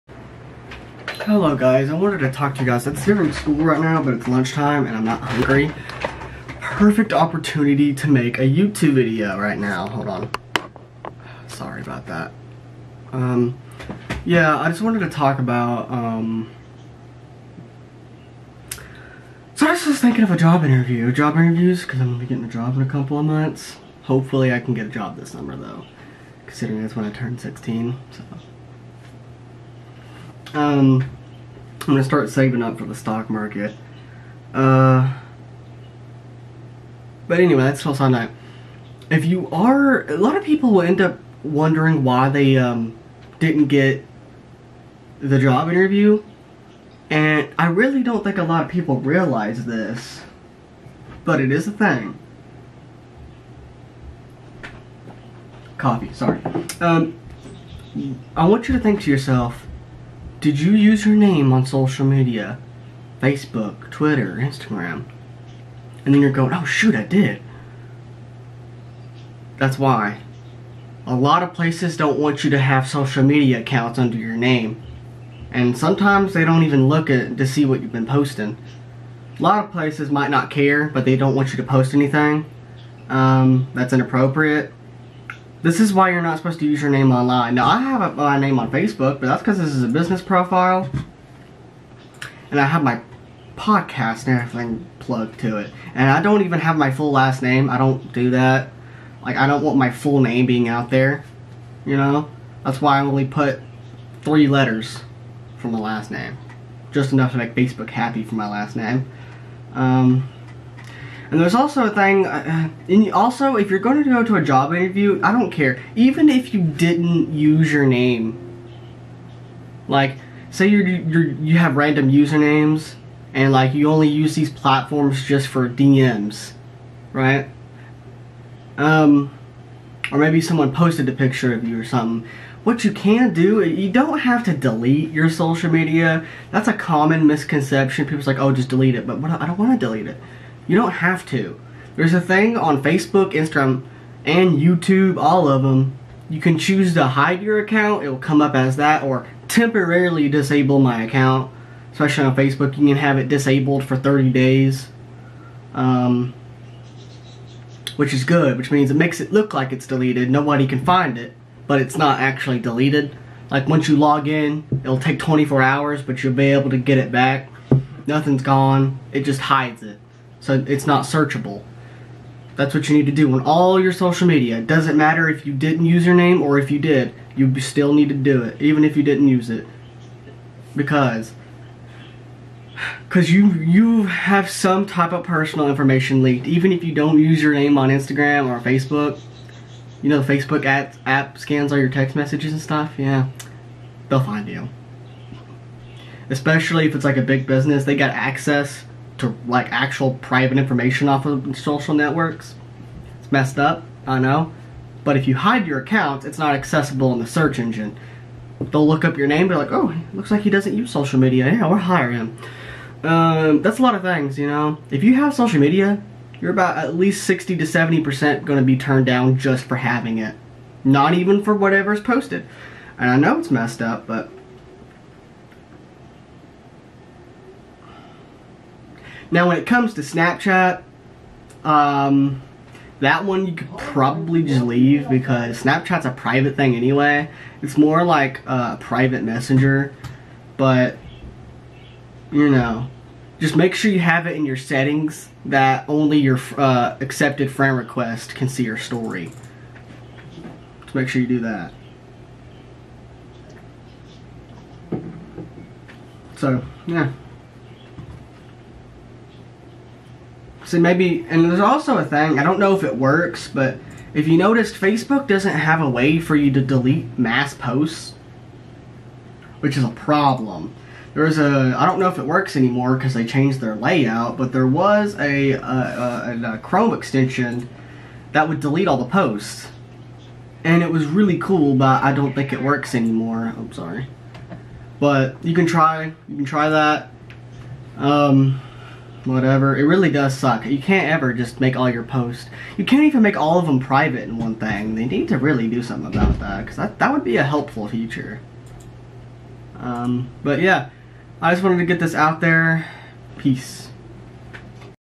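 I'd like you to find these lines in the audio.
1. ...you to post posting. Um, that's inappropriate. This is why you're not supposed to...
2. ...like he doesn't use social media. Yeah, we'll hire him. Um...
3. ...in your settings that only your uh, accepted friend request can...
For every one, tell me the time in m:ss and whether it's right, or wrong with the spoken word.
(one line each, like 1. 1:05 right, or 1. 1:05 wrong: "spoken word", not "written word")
1. 1:21 wrong: "anything", not "posting"
2. 3:30 right
3. 4:04 right.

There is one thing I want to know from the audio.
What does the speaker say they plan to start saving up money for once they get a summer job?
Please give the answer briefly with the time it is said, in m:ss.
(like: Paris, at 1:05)
the stock market, at 0:32.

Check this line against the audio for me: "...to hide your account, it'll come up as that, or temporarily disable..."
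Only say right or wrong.
right.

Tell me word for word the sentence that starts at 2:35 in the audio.
Um, which is good, which means it makes it look like it's deleted.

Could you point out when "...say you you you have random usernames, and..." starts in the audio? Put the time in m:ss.
2:00.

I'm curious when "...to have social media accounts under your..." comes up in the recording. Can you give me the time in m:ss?
1:12.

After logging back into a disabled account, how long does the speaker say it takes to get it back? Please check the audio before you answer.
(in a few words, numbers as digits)
24 hours.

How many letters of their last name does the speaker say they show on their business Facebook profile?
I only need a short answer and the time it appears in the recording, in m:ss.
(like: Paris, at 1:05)
3, at 1:44.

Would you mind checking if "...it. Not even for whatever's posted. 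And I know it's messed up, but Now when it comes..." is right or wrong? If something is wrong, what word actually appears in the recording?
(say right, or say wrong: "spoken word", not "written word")
right.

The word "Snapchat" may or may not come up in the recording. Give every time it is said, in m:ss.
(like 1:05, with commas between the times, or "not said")
3:50, 3:55.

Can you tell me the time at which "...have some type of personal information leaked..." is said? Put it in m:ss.
3:04.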